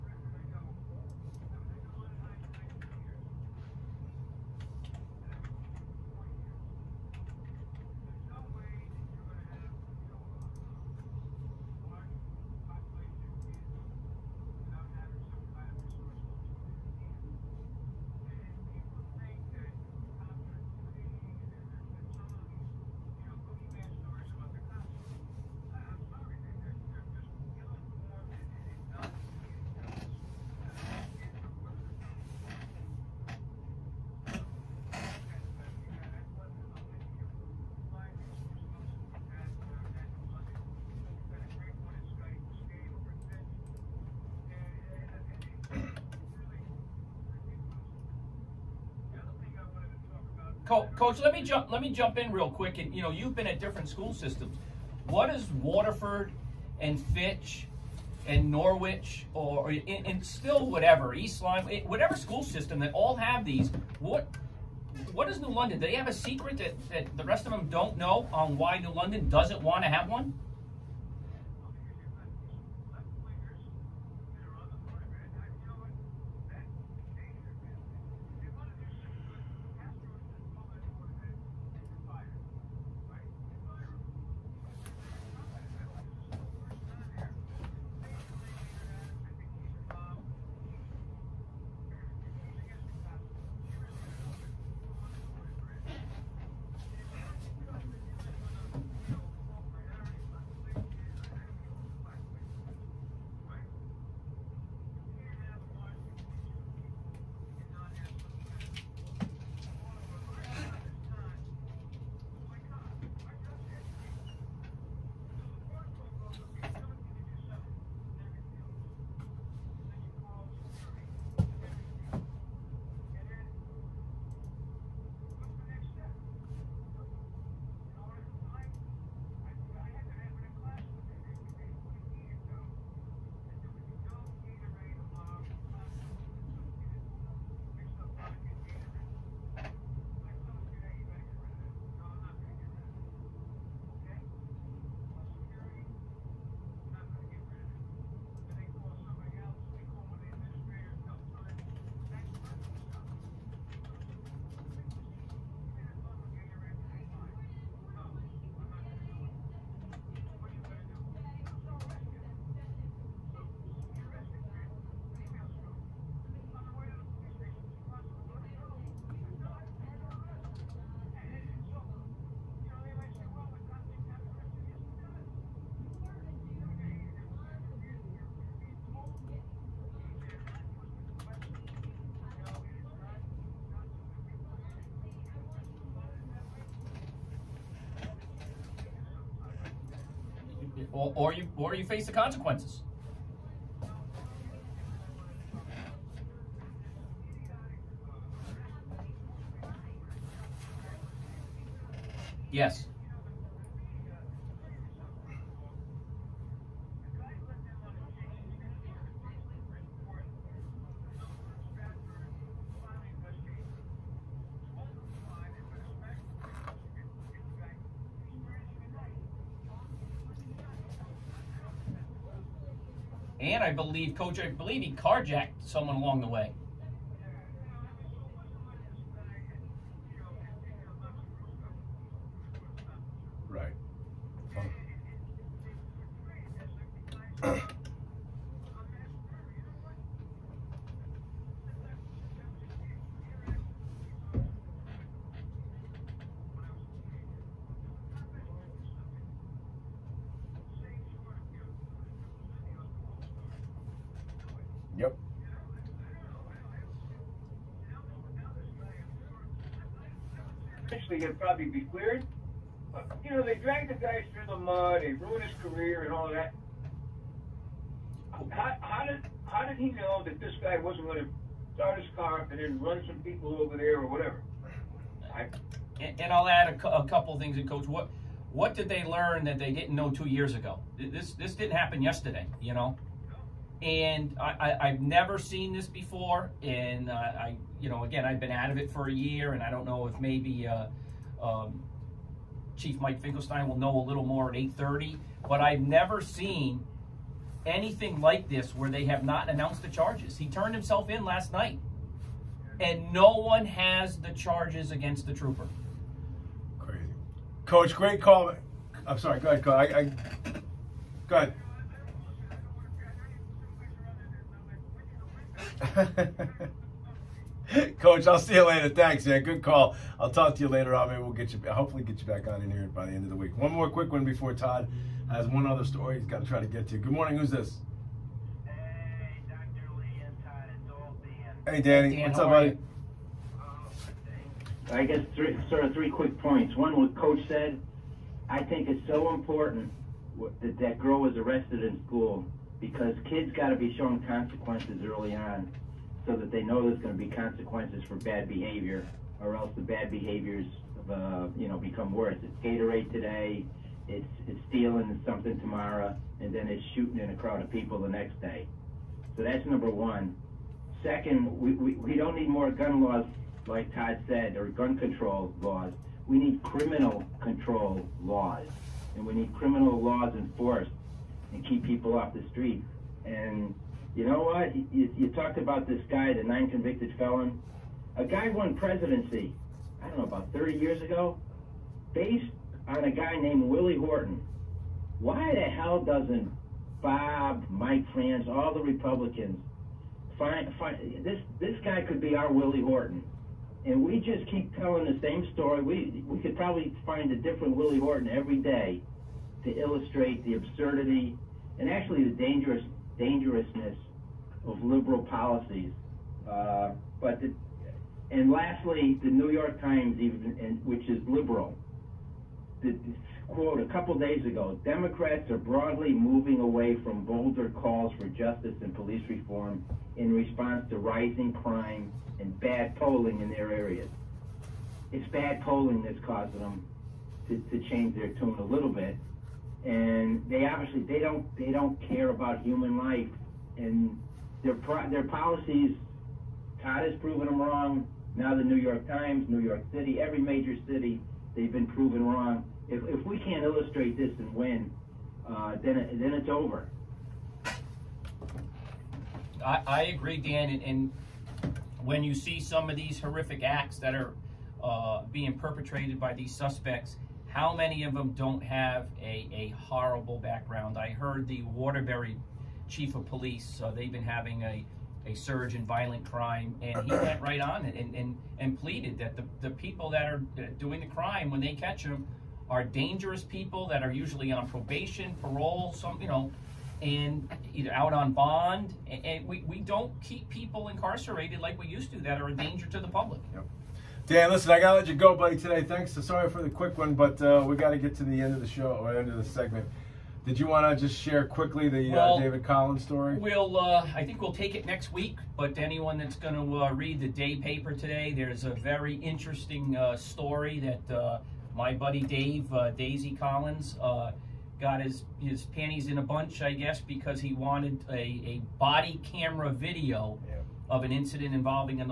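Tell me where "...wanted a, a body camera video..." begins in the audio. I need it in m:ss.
8:27.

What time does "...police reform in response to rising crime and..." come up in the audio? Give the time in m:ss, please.
6:58.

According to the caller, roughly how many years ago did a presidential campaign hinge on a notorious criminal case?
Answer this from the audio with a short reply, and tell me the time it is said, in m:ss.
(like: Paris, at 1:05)
30, at 6:20.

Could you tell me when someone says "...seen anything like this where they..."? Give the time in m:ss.
4:56.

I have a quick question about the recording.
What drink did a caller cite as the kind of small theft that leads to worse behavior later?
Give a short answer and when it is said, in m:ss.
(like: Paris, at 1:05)
Gatorade, at 5:52.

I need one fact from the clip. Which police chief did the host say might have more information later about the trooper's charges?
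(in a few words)
Mike Finkelstein.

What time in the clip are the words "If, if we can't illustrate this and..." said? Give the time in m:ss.
7:22.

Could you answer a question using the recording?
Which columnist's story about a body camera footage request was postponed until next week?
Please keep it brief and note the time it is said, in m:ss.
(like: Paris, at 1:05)
David Collins, at 8:12.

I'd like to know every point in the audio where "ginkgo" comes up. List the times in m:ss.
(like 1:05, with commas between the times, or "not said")
not said.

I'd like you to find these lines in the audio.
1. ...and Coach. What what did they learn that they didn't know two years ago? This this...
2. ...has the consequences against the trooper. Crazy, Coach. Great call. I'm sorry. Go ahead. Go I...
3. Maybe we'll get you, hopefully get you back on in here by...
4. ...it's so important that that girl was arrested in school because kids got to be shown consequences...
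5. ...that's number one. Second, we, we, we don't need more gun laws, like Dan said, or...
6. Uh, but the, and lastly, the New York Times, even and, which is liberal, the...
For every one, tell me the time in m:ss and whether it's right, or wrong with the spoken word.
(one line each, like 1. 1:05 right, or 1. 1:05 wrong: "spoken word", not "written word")
1. 4:37 right
2. 5:03 wrong: "charges", not "consequences"
3. 5:21 right
4. 5:38 right
5. 5:59 wrong: "Todd", not "Dan"
6. 6:46 right.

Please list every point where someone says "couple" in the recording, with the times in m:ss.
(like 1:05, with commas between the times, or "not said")
4:37, 6:53.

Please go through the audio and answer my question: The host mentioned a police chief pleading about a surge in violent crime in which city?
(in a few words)
Waterbury.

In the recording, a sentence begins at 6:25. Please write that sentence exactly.
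Why the hell doesn't Bob, Mike France, all the Republicans find, find this this guy could be our Willie Horton?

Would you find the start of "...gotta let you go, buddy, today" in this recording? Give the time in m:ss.
8:04.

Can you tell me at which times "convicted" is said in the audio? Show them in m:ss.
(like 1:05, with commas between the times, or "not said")
6:16.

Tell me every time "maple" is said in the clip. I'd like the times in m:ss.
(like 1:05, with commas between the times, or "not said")
not said.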